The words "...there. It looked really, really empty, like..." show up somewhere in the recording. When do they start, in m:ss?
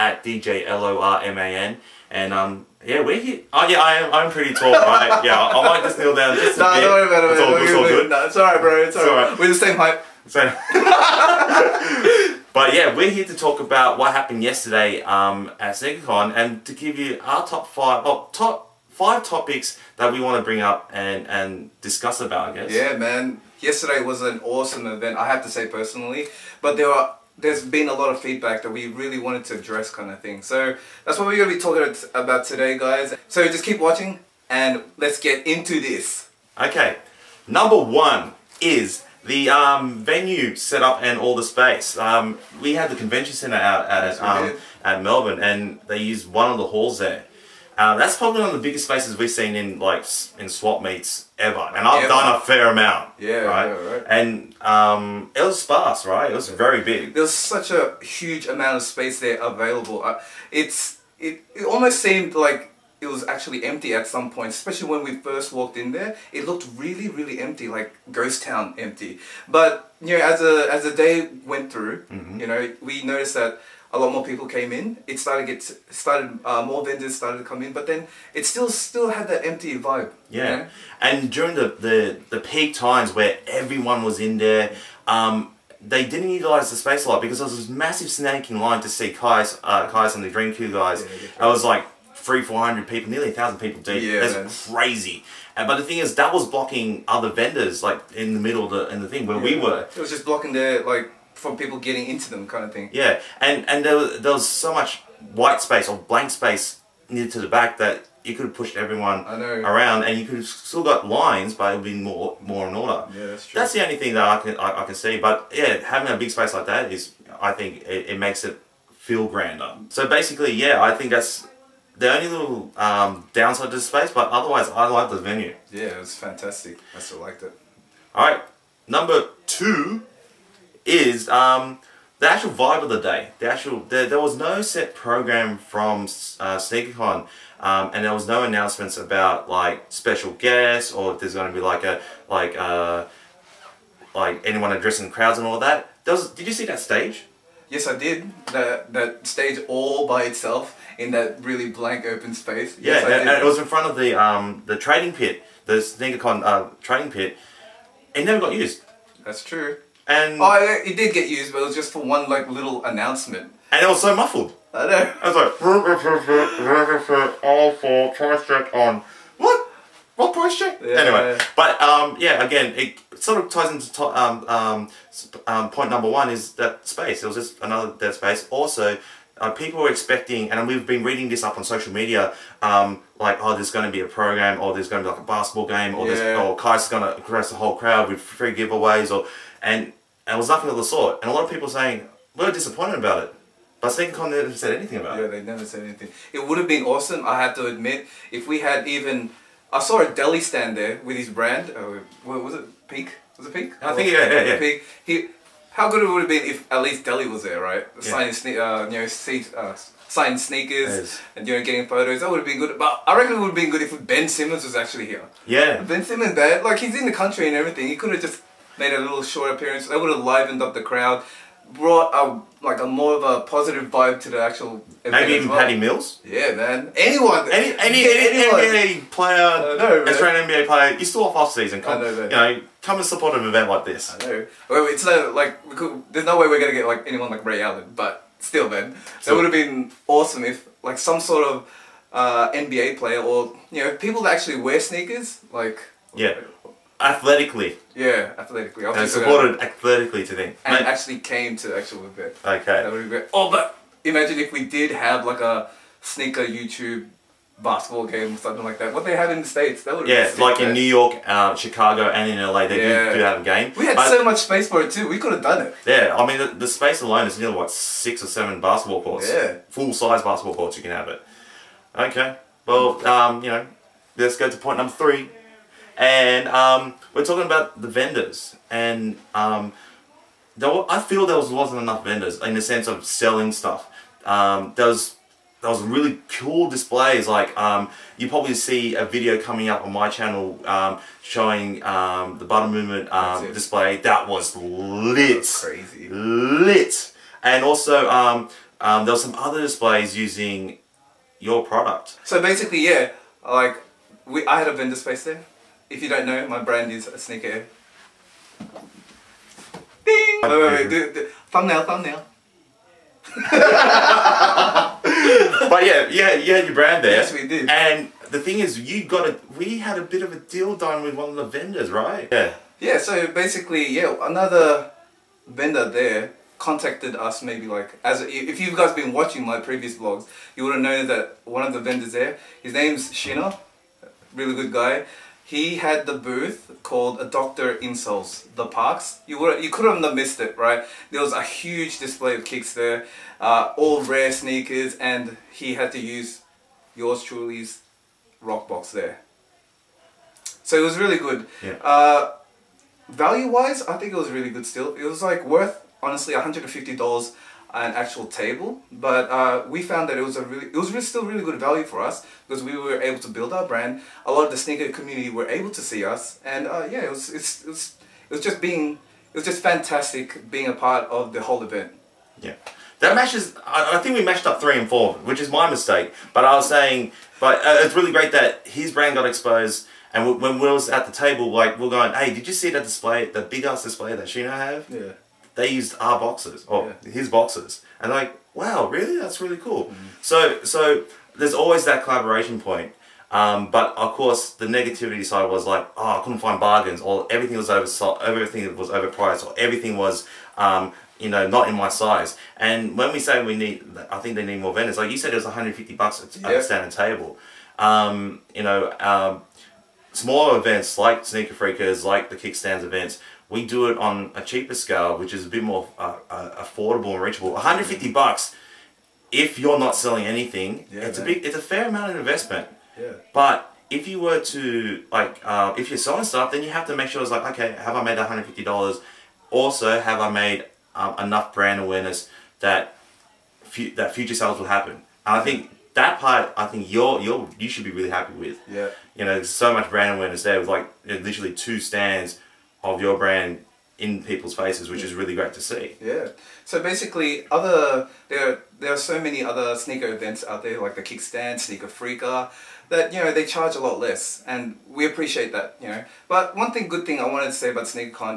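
1:05.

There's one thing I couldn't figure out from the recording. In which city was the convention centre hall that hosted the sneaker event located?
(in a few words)
Melbourne.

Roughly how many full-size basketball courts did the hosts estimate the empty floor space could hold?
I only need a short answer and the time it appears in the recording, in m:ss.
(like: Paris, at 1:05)
6 or 7, at 4:27.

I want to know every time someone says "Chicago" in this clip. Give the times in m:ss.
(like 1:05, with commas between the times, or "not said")
4:21.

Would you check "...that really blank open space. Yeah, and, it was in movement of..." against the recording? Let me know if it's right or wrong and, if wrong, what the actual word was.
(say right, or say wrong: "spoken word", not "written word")
wrong: "front", not "movement".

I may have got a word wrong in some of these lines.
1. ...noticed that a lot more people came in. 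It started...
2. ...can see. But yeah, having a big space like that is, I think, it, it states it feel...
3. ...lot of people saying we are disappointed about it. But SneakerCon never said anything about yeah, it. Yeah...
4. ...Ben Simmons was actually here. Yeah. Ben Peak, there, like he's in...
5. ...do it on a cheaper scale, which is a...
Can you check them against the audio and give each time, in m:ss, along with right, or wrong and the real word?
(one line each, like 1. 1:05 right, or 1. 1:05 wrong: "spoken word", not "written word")
1. 1:13 right
2. 1:54 wrong: "makes", not "states"
3. 3:11 right
4. 3:34 wrong: "Simmons", not "Peak"
5. 6:53 right.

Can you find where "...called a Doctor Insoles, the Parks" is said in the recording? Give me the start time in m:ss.
5:36.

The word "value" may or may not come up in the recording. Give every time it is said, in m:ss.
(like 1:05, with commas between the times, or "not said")
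5:53, 6:01.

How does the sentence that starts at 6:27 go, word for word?
his boxes, and like, wow, really?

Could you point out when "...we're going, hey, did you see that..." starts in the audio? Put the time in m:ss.
6:21.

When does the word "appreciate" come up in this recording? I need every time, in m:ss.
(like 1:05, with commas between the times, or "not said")
7:35.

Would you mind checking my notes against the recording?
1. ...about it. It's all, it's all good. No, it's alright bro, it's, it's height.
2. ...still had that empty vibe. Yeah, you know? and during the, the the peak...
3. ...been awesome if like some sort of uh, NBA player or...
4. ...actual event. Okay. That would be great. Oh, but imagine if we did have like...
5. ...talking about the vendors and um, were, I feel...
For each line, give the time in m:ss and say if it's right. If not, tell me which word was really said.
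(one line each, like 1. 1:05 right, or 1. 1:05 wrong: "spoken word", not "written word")
1. 0:07 wrong: "alright", not "height"
2. 1:18 right
3. 3:59 right
4. 4:11 right
5. 4:37 right.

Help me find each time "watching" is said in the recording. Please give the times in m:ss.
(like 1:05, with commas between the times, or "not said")
0:33, 5:29.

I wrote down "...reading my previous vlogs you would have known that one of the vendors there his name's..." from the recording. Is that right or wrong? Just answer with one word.
wrong.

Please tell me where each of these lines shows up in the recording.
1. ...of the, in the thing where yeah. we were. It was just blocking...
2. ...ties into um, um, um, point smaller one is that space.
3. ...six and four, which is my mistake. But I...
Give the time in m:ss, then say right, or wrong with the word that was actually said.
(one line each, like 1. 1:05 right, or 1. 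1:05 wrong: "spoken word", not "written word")
1. 1:38 right
2. 2:53 wrong: "number", not "smaller"
3. 6:14 wrong: "three", not "six".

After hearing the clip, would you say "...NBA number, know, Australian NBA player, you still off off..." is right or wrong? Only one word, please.
wrong.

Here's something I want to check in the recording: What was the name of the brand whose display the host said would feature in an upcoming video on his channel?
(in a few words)
Butter.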